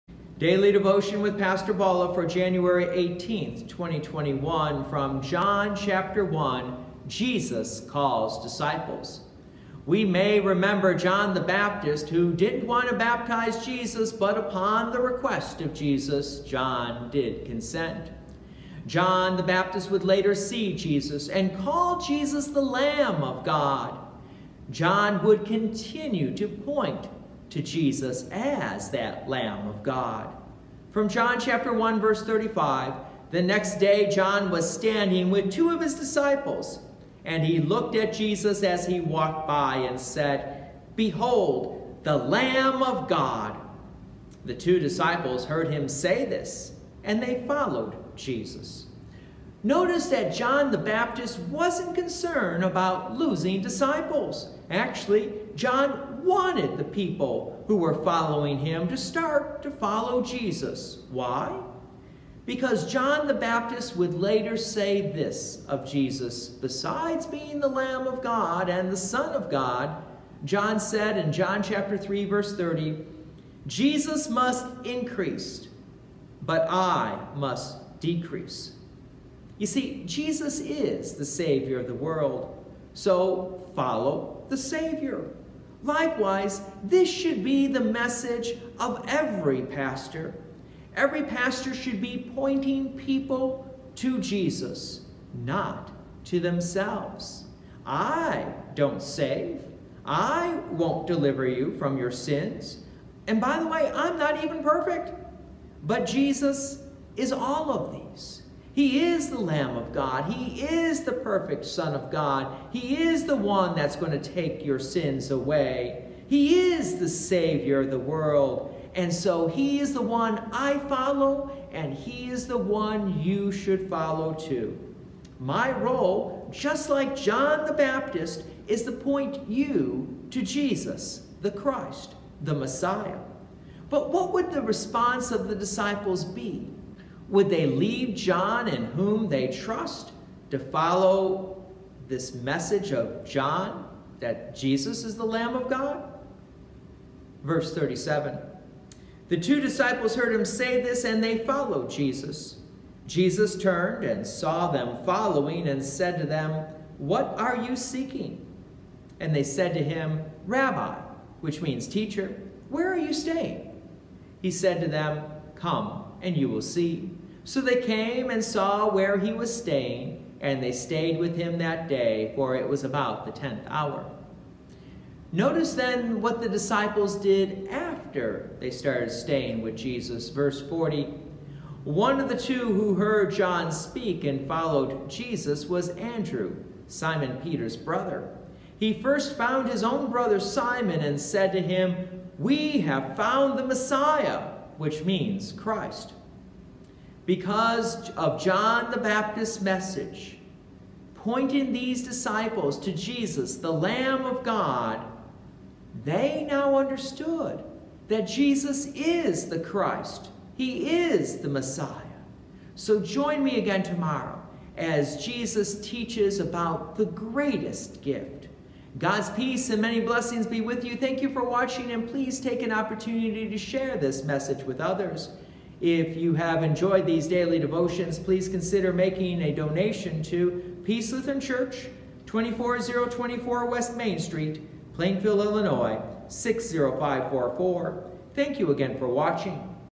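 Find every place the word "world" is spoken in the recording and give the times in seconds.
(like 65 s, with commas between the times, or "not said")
81 s, 117 s.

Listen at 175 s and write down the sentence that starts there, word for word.
Notice then what the disciples did after they started staying with Jesus.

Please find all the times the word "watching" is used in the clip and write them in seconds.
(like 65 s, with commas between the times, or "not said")
221 s, 239 s.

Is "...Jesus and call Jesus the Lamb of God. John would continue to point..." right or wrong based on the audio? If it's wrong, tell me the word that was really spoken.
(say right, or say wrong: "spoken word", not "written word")
right.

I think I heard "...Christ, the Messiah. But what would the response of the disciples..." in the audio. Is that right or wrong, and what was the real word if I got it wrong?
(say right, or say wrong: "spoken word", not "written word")
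right.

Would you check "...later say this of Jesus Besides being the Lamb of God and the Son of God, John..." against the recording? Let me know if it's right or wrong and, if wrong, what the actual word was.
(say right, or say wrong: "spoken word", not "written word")
right.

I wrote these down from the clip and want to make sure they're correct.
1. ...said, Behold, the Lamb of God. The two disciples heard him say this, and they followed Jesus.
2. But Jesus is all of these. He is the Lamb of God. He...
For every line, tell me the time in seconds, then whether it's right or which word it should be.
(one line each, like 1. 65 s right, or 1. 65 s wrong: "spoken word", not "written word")
1. 39 s right
2. 105 s right.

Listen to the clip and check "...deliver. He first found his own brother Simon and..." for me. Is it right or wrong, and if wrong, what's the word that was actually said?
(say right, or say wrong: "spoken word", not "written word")
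wrong: "brother", not "deliver".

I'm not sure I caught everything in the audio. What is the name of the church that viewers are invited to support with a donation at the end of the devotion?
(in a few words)
Peace Lutheran Church.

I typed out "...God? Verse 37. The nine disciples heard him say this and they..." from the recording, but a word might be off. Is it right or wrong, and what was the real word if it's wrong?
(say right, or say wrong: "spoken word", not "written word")
wrong: "two", not "nine".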